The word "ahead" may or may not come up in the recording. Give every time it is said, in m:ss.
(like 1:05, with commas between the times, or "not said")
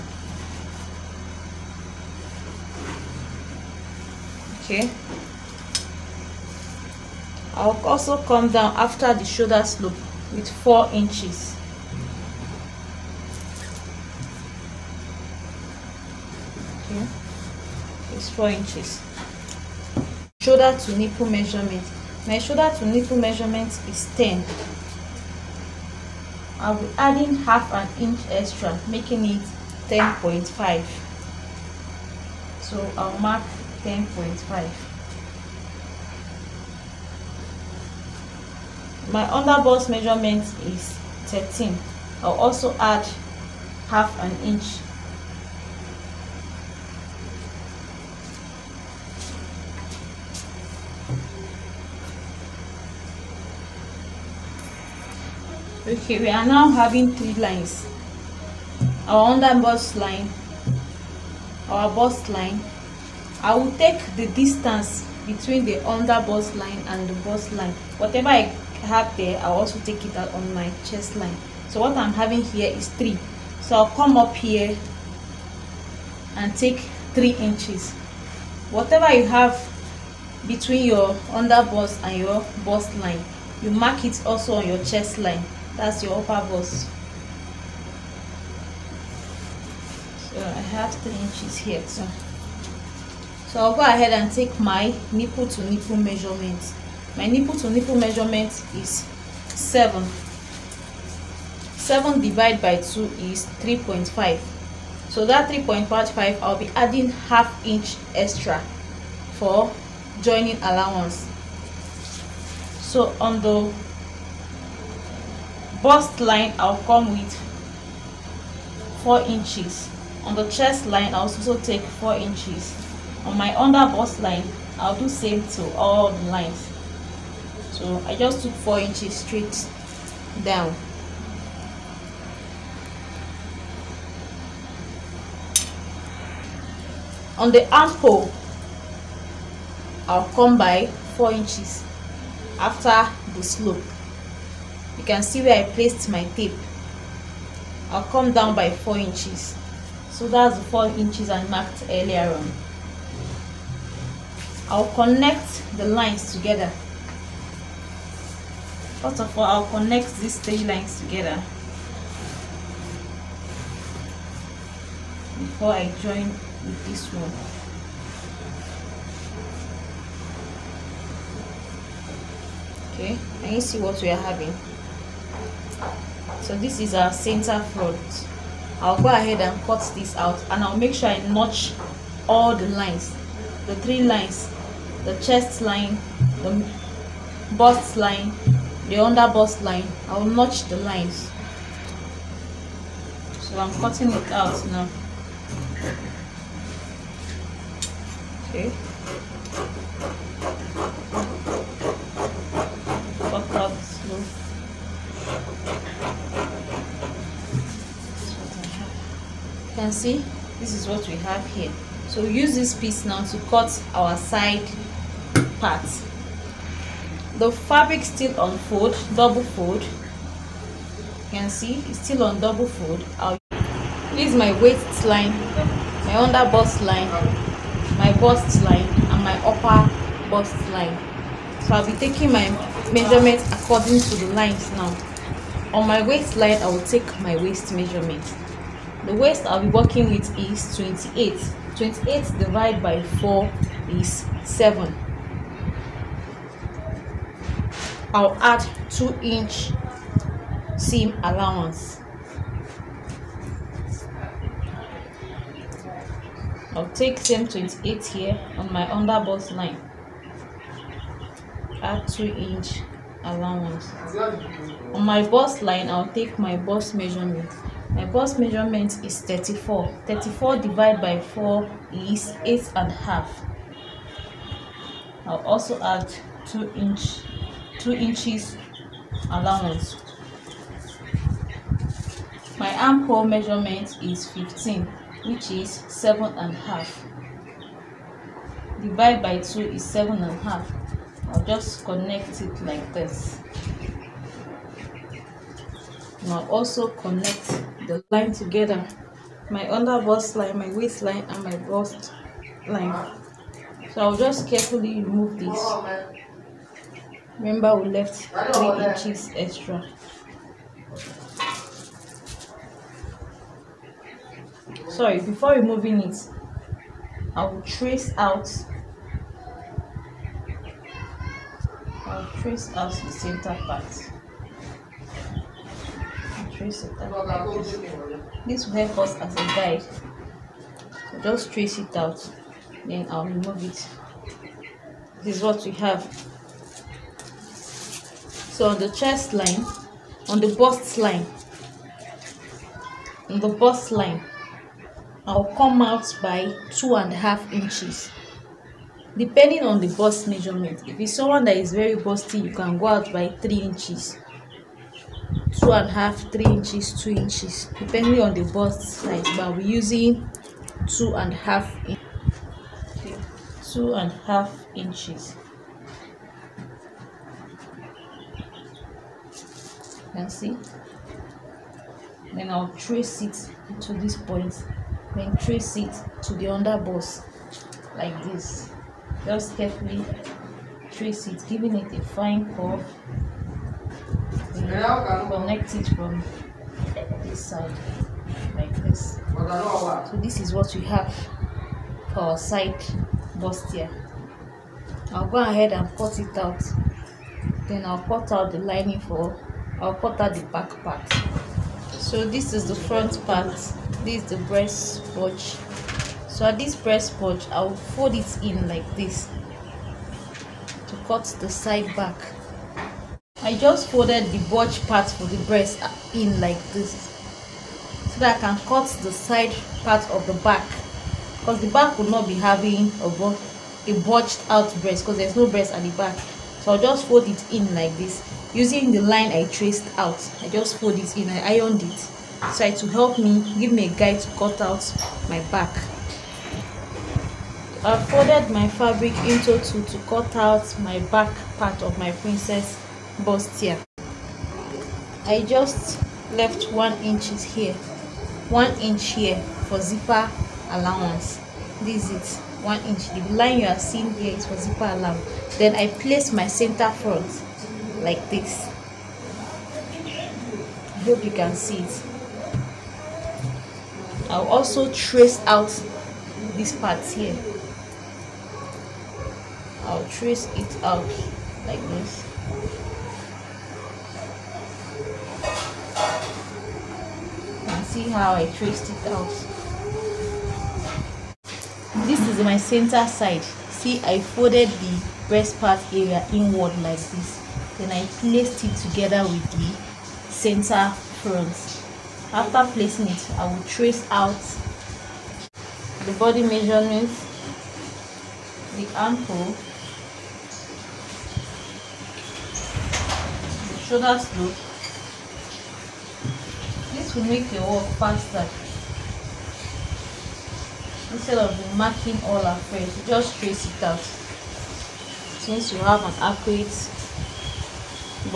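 1:33, 2:59, 6:35.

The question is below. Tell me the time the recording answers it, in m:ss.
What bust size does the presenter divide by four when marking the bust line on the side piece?
4:27.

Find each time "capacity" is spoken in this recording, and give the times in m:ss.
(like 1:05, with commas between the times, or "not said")
not said.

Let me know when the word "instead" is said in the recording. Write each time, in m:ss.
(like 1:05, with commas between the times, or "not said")
8:31.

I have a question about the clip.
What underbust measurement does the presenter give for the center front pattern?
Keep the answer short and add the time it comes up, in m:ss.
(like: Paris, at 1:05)
13, at 0:39.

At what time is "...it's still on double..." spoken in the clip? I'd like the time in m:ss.
3:41.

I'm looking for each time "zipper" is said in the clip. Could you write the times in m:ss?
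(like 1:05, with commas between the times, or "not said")
7:29, 7:34.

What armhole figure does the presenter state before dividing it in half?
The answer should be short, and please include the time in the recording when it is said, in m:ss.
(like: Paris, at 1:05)
15, at 4:42.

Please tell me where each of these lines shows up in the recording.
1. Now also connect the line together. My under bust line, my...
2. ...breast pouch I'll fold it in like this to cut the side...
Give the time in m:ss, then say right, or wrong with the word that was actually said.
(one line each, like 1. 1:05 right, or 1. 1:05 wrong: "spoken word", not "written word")
1. 4:56 right
2. 6:46 right.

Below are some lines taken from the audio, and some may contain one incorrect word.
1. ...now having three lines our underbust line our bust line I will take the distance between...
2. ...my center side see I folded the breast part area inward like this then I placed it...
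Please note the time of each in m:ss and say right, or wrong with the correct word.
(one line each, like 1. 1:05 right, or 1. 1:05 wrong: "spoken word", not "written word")
1. 0:56 right
2. 8:02 right.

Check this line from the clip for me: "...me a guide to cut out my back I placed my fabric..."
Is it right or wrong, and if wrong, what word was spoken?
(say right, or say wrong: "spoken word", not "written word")
wrong: "folded", not "placed".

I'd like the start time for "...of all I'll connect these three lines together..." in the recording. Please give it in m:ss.
2:39.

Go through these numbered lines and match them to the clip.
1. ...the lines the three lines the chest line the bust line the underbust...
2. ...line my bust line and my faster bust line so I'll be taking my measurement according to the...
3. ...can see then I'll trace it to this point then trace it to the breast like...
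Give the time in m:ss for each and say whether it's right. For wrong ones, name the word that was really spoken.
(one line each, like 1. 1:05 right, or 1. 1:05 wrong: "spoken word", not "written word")
1. 3:02 right
2. 3:46 wrong: "upper", not "faster"
3. 6:10 wrong: "underbust", not "breast".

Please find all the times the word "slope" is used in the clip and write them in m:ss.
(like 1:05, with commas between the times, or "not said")
0:09, 2:23, 8:24.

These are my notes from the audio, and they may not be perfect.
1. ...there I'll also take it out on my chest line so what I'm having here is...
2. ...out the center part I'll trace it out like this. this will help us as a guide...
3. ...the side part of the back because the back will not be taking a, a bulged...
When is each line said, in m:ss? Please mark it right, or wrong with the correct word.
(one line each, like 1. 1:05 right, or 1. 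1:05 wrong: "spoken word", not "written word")
1. 1:09 right
2. 5:22 right
3. 6:59 wrong: "having", not "taking".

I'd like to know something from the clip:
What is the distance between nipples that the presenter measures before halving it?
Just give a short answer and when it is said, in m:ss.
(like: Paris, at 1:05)
7, at 1:41.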